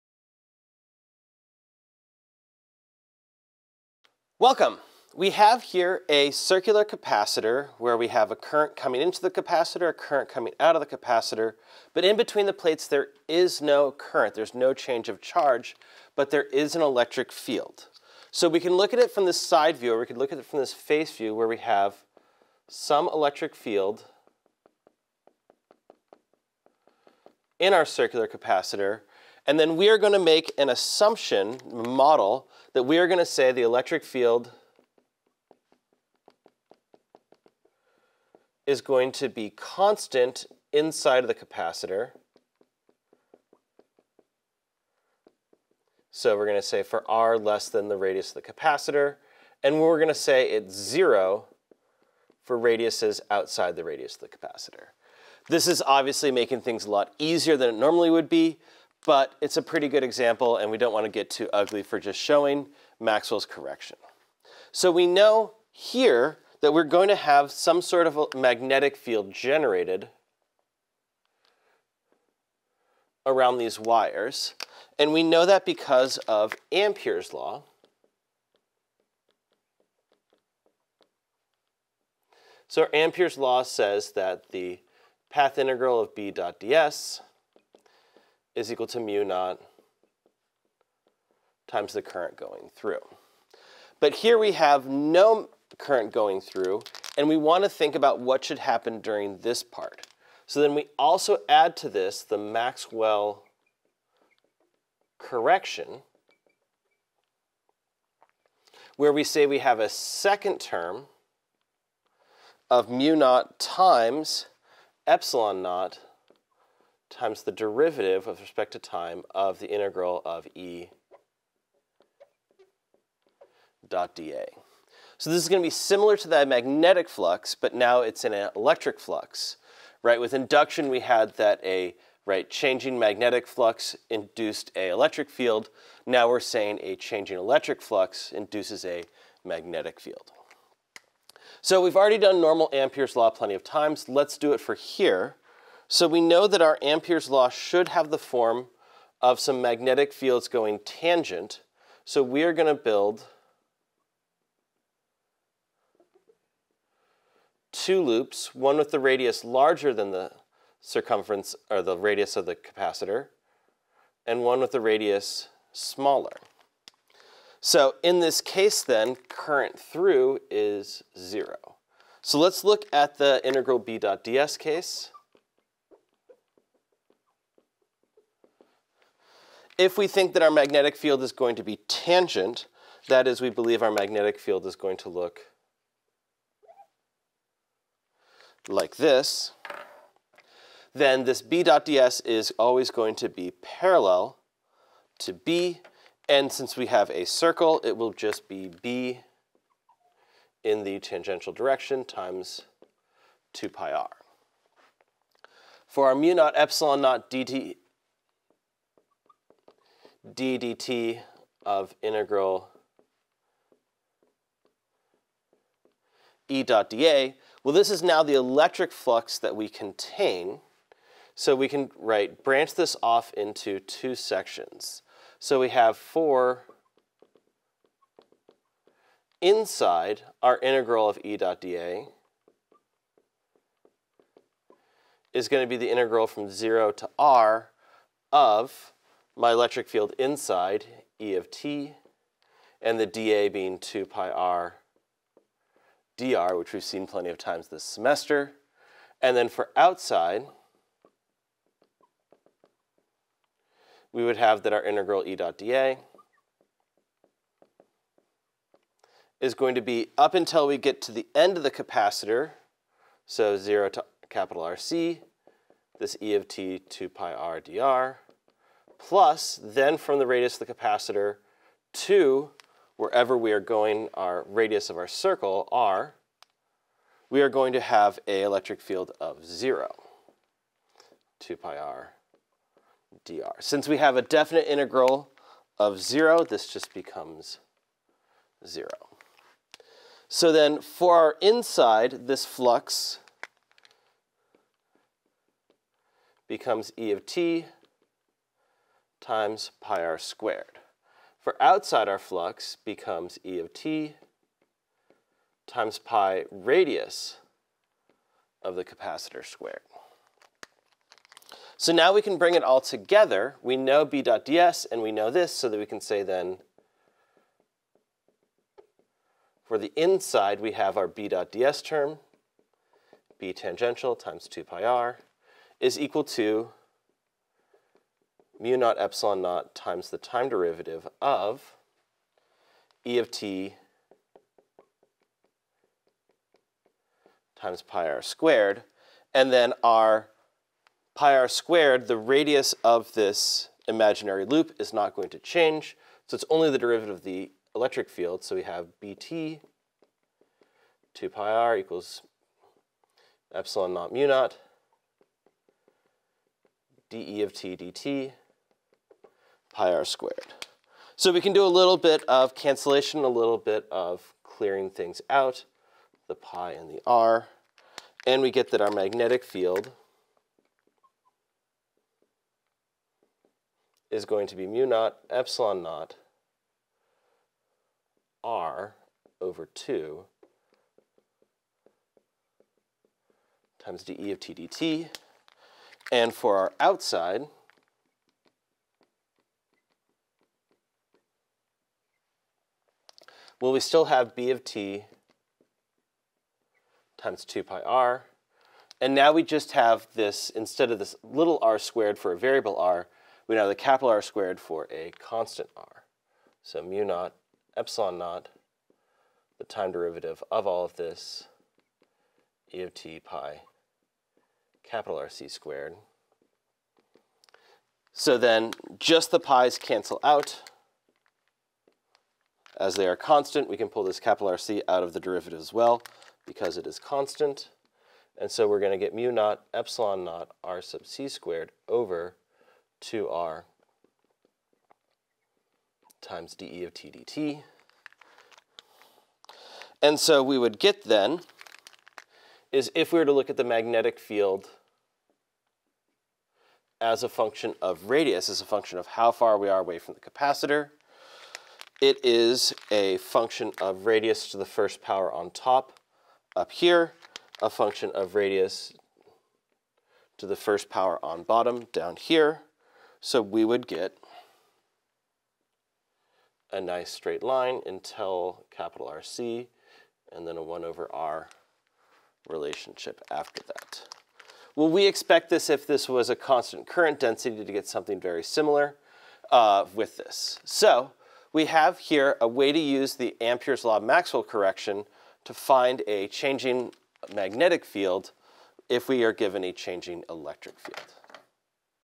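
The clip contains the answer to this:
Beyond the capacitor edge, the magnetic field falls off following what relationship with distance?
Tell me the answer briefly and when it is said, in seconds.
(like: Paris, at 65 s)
1 over R, at 470 s.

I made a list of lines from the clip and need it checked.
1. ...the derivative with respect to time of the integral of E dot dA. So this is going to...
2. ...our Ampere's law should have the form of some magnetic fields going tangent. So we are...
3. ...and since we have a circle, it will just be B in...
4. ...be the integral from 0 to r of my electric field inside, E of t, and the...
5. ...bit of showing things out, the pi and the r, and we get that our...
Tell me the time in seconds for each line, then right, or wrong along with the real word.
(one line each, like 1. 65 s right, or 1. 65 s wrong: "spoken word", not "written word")
1. 117 s right
2. 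146 s right
3. 196 s right
4. 235 s right
5. 363 s wrong: "clearing", not "showing".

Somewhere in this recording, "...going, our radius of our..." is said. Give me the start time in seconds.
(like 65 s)
273 s.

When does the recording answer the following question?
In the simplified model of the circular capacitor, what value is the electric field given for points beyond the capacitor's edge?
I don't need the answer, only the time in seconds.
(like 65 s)
50 s.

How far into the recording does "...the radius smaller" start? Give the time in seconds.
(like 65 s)
164 s.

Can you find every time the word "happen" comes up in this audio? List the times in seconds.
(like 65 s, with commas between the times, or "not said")
98 s.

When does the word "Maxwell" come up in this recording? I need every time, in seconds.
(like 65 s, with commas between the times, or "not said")
62 s, 102 s, 483 s.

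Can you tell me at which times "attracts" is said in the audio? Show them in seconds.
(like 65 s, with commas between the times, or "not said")
not said.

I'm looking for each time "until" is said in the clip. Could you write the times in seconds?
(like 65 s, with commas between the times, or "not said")
260 s, 467 s.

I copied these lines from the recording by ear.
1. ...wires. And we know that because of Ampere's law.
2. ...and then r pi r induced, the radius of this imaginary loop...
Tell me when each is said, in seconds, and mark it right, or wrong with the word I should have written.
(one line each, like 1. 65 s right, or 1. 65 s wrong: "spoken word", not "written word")
1. 73 s right
2. 339 s wrong: "squared", not "induced".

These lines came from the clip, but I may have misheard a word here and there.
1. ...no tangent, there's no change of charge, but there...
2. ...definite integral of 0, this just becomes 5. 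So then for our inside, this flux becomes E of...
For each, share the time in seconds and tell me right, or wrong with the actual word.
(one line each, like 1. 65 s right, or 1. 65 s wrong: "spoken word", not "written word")
1. 13 s wrong: "current", not "tangent"
2. 284 s wrong: "0", not "5".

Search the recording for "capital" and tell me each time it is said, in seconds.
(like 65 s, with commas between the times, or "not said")
264 s, 403 s, 414 s, 424 s, 468 s.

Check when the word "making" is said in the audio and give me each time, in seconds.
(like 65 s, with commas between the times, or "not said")
56 s.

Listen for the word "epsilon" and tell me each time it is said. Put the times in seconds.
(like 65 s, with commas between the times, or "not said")
115 s, 206 s, 328 s, 353 s, 375 s, 407 s, 429 s.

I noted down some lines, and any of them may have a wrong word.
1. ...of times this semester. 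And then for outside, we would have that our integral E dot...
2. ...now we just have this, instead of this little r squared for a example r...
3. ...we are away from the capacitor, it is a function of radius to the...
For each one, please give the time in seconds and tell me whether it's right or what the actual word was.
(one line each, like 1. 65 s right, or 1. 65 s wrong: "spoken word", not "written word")
1. 247 s right
2. 399 s wrong: "variable", not "example"
3. 449 s right.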